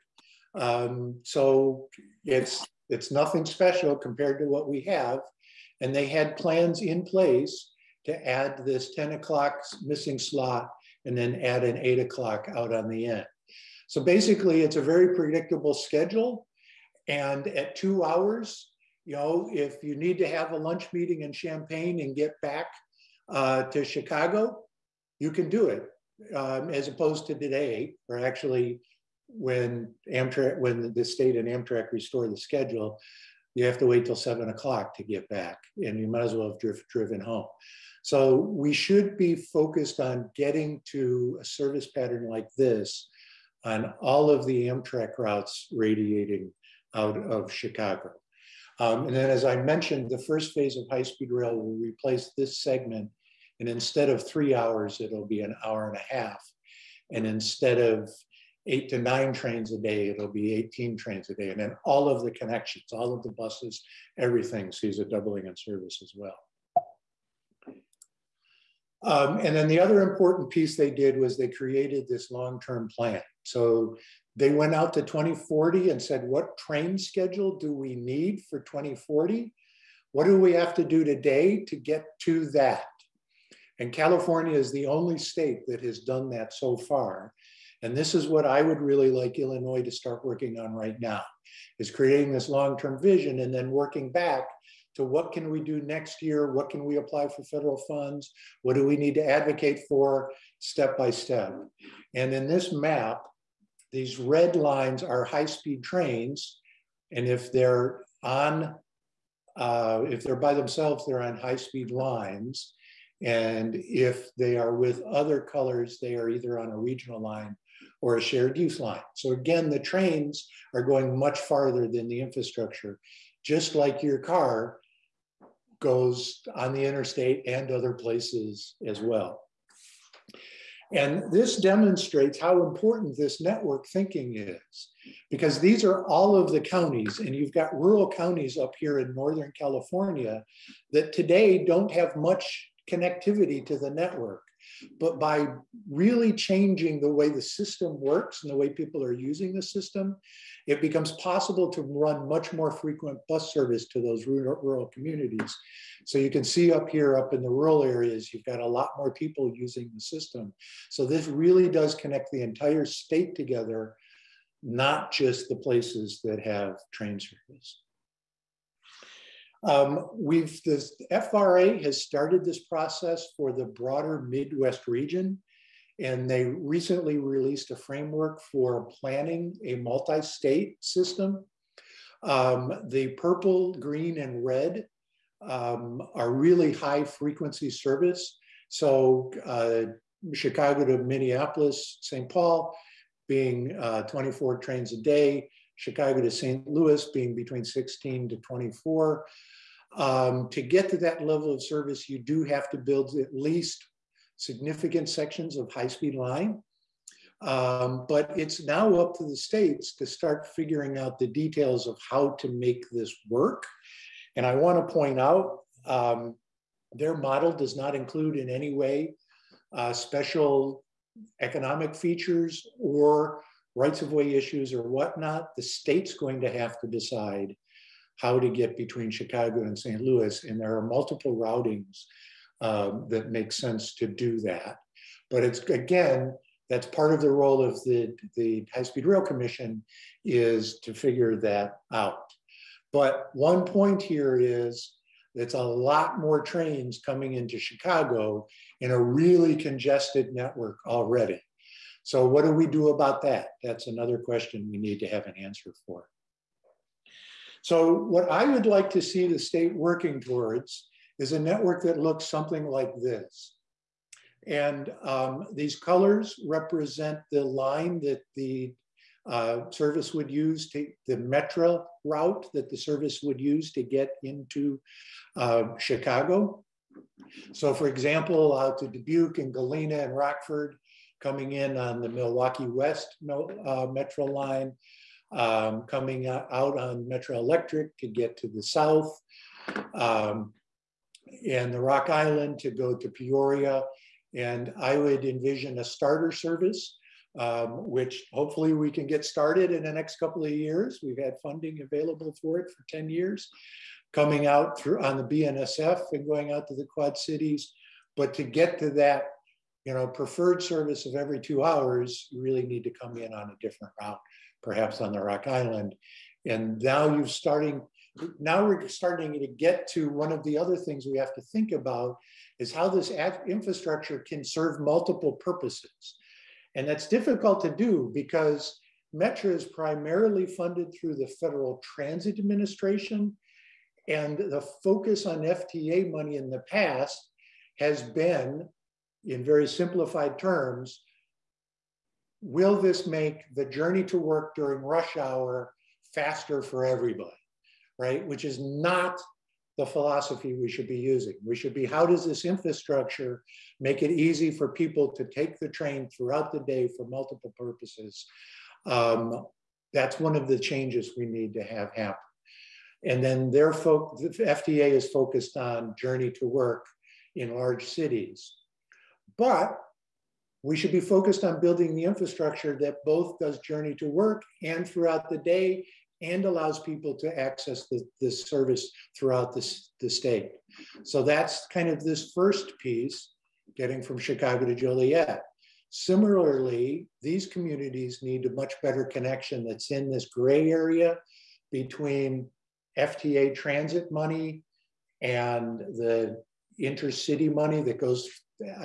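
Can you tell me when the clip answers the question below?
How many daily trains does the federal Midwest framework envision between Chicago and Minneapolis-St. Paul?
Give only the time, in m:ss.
3:14.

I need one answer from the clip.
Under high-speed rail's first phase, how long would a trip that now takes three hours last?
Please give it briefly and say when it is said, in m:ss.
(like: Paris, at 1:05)
an hour and a half, at 0:55.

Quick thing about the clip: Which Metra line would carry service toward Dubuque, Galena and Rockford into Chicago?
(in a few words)
Milwaukee West.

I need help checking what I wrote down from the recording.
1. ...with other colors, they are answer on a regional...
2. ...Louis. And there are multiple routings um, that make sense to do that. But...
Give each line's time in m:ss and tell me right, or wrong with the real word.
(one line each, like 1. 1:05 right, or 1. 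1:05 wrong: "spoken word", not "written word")
1. 1:54 wrong: "either", not "answer"
2. 3:49 right.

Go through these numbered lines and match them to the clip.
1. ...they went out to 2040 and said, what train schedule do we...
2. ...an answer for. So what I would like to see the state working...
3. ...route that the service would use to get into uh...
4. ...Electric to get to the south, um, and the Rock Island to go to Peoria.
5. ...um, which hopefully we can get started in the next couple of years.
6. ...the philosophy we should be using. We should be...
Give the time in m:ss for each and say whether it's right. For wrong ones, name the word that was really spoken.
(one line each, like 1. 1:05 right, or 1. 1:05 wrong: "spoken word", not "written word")
1. 1:14 right
2. 4:15 right
3. 4:32 right
4. 4:47 right
5. 4:57 right
6. 5:49 right.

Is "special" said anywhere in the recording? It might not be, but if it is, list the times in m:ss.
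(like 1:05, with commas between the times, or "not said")
0:03, 3:39.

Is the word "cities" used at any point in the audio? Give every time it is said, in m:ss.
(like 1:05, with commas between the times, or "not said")
5:07, 6:07.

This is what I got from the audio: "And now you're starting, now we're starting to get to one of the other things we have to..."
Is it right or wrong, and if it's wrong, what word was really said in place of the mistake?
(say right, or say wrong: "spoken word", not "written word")
right.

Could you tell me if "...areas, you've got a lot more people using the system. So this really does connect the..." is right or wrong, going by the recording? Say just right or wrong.
right.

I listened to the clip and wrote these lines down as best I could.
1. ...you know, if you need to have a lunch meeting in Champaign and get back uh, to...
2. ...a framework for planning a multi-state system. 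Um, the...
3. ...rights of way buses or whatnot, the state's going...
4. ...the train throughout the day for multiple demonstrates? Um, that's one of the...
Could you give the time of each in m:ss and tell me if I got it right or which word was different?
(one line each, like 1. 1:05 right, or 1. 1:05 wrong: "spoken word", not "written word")
1. 0:19 right
2. 2:57 right
3. 3:43 wrong: "issues", not "buses"
4. 5:55 wrong: "purposes", not "demonstrates".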